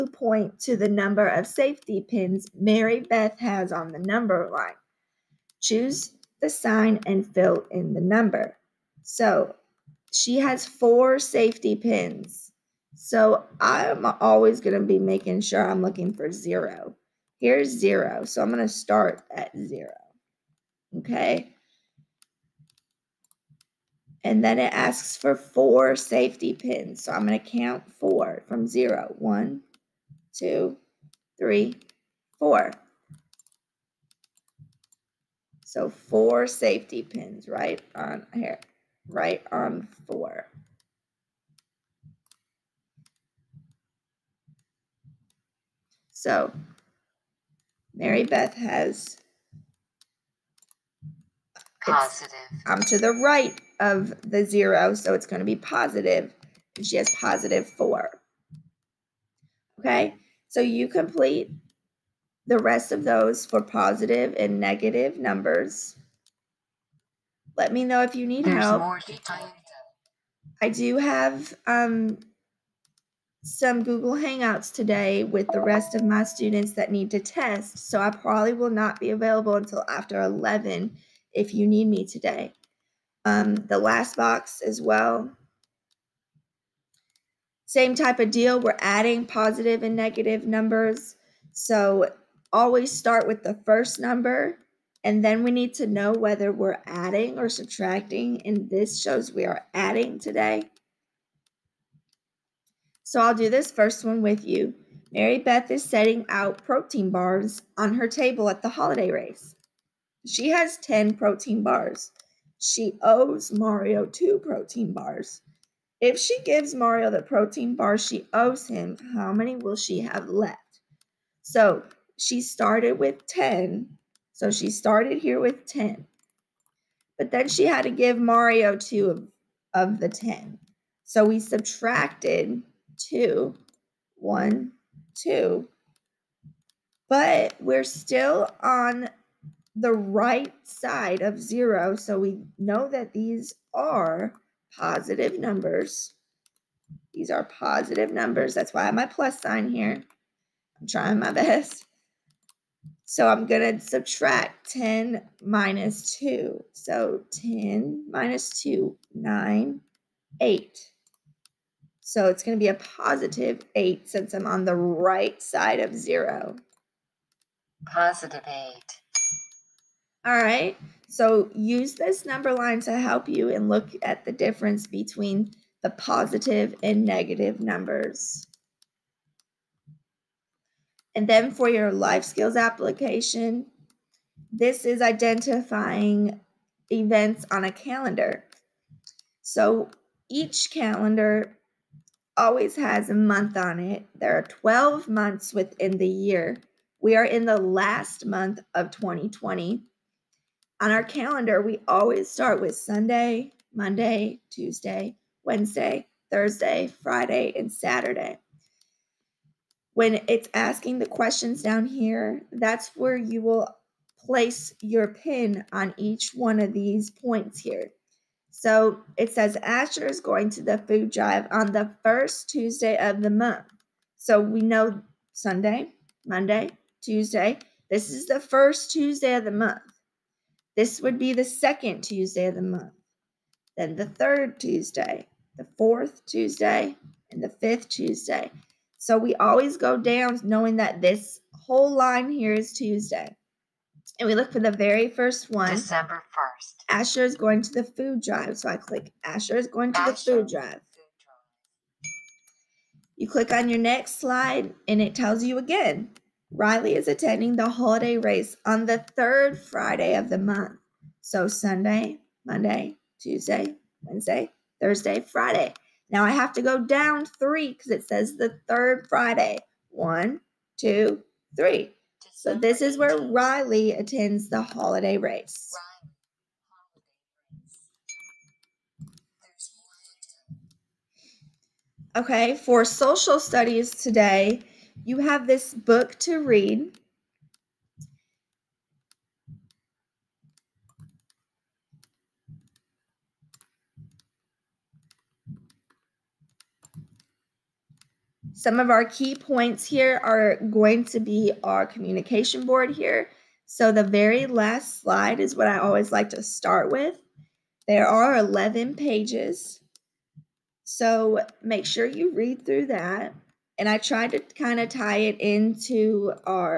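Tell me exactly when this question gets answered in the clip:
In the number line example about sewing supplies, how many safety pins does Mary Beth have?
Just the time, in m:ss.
0:10.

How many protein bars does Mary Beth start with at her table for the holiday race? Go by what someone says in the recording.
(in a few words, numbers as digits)
10.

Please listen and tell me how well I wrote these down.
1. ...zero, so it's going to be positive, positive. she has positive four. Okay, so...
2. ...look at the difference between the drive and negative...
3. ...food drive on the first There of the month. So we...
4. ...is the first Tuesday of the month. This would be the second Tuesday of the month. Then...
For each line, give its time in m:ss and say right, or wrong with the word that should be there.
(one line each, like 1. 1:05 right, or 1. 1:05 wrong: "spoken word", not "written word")
1. 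0:54 right
2. 2:53 wrong: "positive", not "drive"
3. 3:40 wrong: "Tuesday", not "There"
4. 3:48 right.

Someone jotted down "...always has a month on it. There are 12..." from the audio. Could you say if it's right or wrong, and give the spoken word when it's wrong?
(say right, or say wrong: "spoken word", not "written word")
right.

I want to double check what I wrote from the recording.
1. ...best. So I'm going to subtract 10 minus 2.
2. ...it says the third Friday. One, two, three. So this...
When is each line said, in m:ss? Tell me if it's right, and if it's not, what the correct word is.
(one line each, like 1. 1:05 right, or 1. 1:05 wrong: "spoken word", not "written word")
1. 2:31 right
2. 4:27 right.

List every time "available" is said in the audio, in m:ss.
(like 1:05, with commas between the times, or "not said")
1:19.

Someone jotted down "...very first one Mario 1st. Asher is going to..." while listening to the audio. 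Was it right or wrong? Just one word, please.
wrong.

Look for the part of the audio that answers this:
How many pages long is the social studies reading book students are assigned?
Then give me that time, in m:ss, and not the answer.
5:07.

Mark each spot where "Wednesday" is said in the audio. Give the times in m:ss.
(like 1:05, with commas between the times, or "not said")
3:25, 4:24.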